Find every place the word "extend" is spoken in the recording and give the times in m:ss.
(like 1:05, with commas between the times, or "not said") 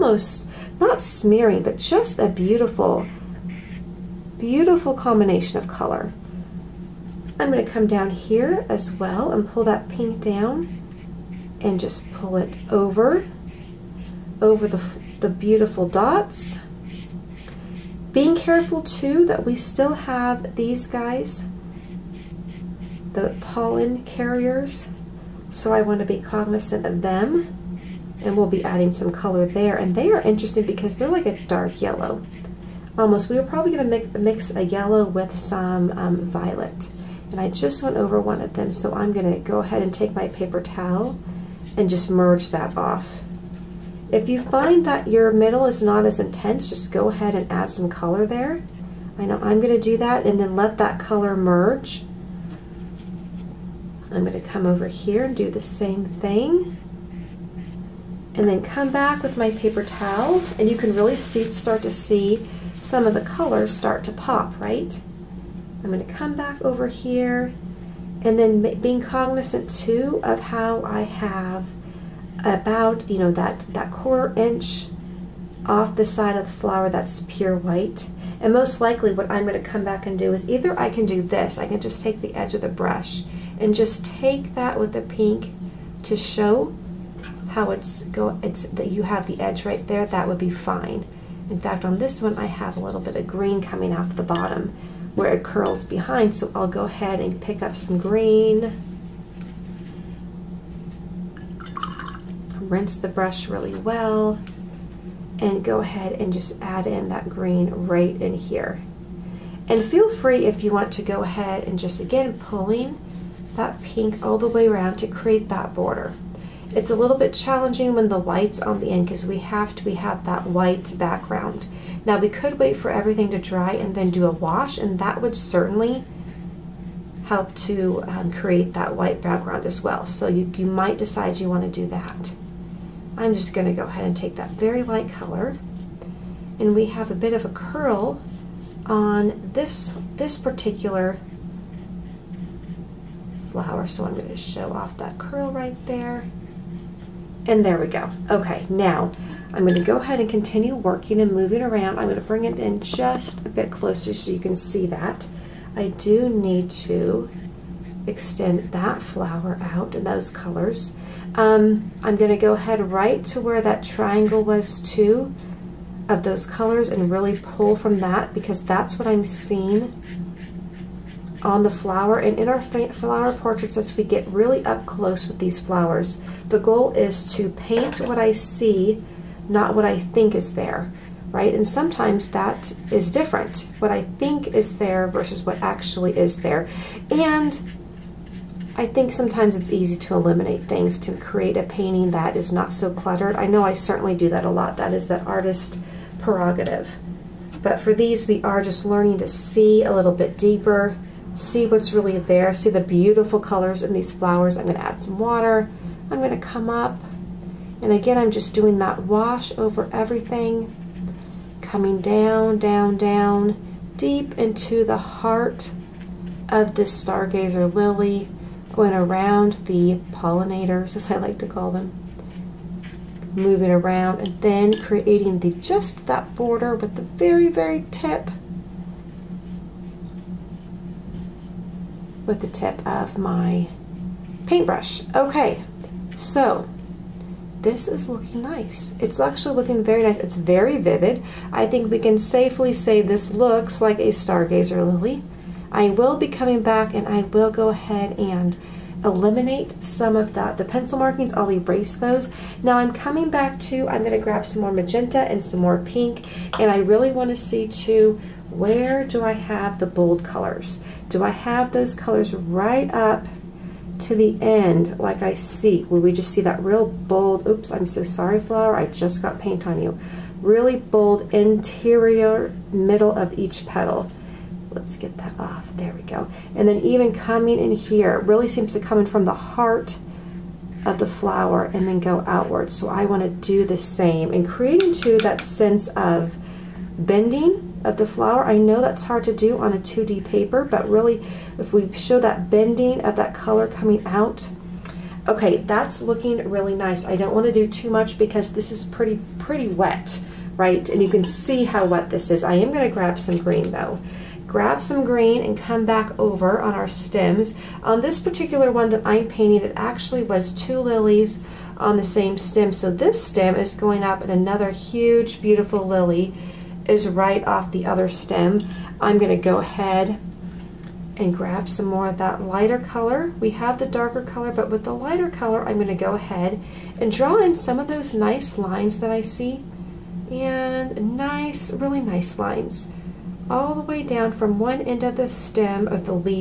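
2:38.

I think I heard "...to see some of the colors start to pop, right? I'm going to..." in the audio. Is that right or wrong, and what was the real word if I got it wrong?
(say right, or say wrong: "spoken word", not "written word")
right.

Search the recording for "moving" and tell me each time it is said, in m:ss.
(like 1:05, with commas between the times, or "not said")
2:31, 3:43.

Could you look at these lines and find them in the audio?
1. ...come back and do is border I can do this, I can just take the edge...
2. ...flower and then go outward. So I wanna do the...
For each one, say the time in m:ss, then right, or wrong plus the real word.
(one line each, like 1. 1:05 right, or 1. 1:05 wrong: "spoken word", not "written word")
1. 1:19 wrong: "either", not "border"
2. 4:41 right.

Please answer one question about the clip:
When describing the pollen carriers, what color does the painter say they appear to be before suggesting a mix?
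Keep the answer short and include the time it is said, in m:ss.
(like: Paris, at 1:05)
dark yellow, at 0:31.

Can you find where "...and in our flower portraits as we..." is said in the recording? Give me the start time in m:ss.
2:52.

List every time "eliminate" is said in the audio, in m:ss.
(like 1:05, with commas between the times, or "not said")
3:10, 4:09.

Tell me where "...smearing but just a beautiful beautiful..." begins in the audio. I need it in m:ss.
0:01.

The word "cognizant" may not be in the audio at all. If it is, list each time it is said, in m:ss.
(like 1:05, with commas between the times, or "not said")
0:26, 1:09.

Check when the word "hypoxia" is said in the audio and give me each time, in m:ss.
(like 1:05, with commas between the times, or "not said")
not said.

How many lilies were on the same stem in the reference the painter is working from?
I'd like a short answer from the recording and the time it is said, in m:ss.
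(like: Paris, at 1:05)
2, at 5:10.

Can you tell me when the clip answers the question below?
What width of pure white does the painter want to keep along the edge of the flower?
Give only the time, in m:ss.
1:13.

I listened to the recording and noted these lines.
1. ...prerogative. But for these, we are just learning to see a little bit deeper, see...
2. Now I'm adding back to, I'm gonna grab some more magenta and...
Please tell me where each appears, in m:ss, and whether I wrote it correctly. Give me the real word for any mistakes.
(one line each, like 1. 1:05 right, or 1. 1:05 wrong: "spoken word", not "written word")
1. 3:16 right
2. 4:12 wrong: "coming", not "adding".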